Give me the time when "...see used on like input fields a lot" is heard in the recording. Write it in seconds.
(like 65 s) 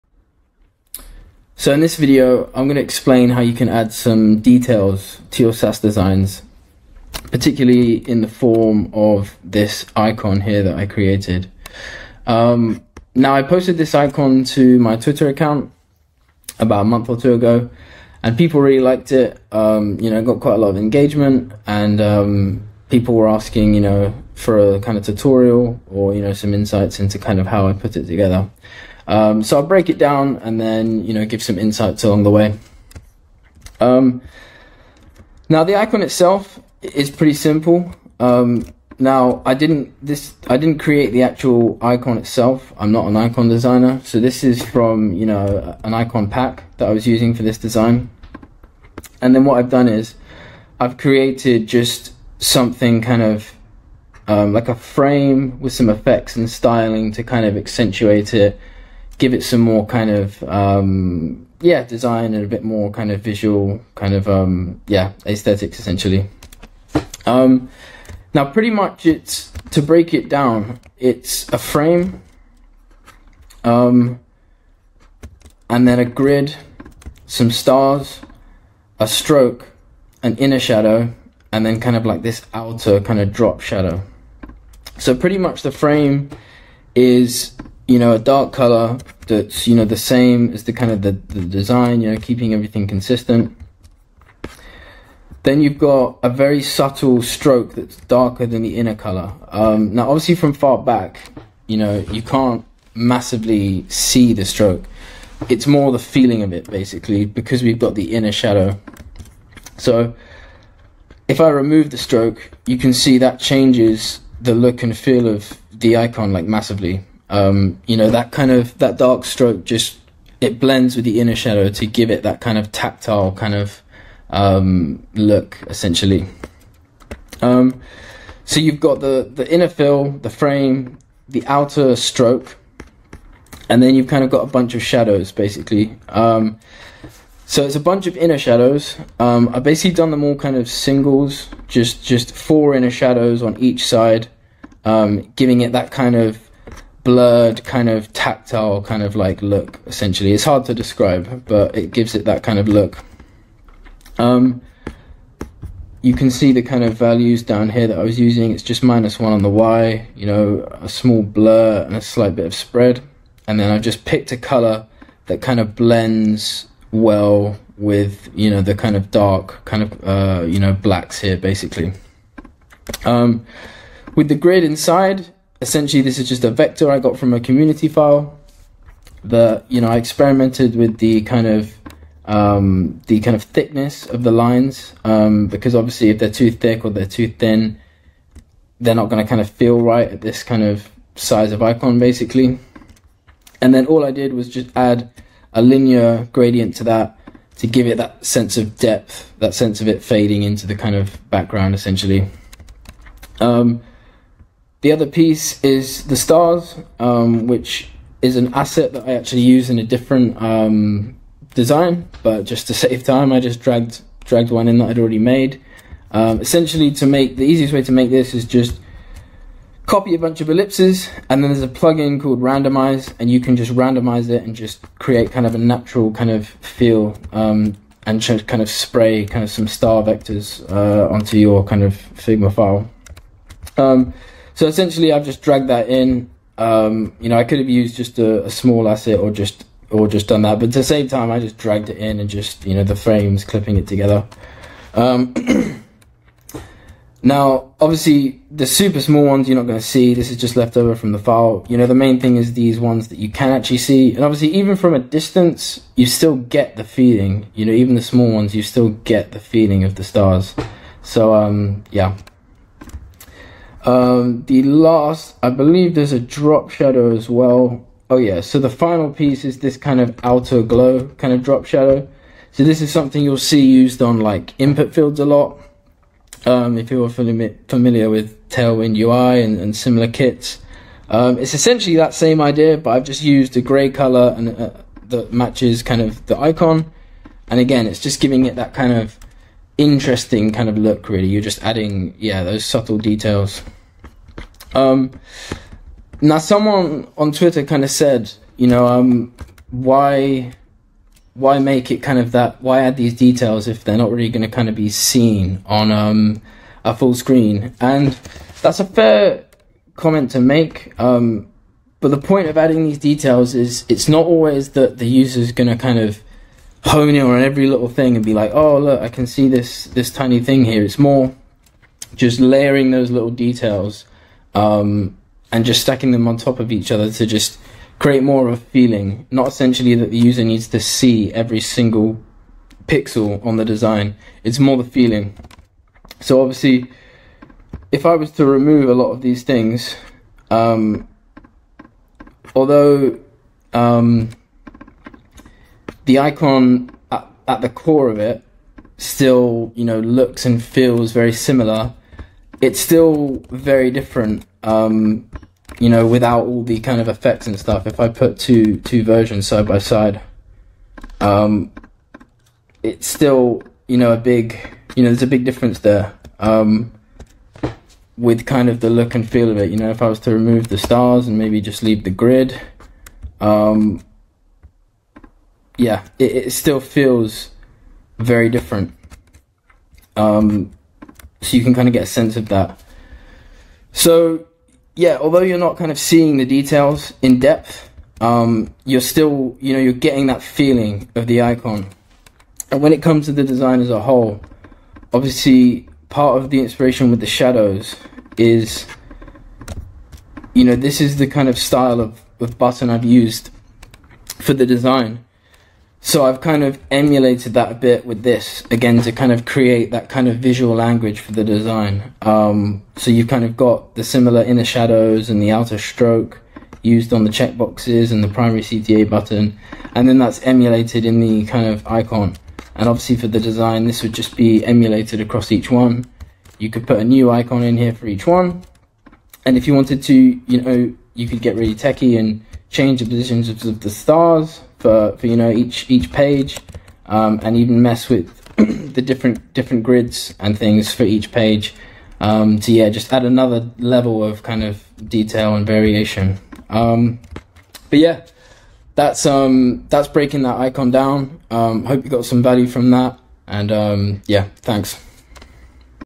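273 s.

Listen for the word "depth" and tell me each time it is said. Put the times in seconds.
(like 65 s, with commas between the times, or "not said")
198 s, 387 s.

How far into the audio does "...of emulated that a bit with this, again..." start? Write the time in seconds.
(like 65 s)
406 s.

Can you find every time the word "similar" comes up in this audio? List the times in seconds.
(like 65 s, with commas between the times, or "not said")
279 s, 351 s, 414 s.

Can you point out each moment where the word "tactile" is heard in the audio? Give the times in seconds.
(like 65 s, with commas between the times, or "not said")
122 s, 148 s.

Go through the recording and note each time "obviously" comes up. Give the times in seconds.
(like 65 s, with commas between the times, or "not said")
100 s, 185 s, 247 s, 254 s, 336 s, 395 s, 422 s.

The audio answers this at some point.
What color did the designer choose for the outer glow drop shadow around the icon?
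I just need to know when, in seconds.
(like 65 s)
283 s.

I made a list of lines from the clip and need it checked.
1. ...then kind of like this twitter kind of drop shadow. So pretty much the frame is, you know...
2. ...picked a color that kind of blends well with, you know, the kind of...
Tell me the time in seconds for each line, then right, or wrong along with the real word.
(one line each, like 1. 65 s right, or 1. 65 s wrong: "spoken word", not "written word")
1. 81 s wrong: "outer", not "twitter"
2. 164 s right.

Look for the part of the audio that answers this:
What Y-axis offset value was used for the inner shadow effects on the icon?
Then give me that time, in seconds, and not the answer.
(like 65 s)
158 s.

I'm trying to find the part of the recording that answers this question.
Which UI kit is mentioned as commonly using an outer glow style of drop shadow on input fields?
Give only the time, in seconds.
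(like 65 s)
278 s.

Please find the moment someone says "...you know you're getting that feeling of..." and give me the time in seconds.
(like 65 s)
389 s.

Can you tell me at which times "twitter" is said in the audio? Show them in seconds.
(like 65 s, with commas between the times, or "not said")
14 s, 297 s.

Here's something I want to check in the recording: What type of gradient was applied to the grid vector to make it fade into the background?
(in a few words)
Linear gradient.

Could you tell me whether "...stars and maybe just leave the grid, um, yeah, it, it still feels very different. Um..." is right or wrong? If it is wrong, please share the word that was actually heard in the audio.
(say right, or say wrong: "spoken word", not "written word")
right.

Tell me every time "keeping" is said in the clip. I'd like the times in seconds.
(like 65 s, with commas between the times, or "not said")
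92 s.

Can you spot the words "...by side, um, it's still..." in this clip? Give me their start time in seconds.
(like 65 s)
359 s.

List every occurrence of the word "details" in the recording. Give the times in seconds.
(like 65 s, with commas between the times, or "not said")
4 s, 292 s, 303 s, 312 s, 323 s, 386 s, 445 s.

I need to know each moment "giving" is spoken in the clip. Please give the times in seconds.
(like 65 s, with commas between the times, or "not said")
145 s, 288 s.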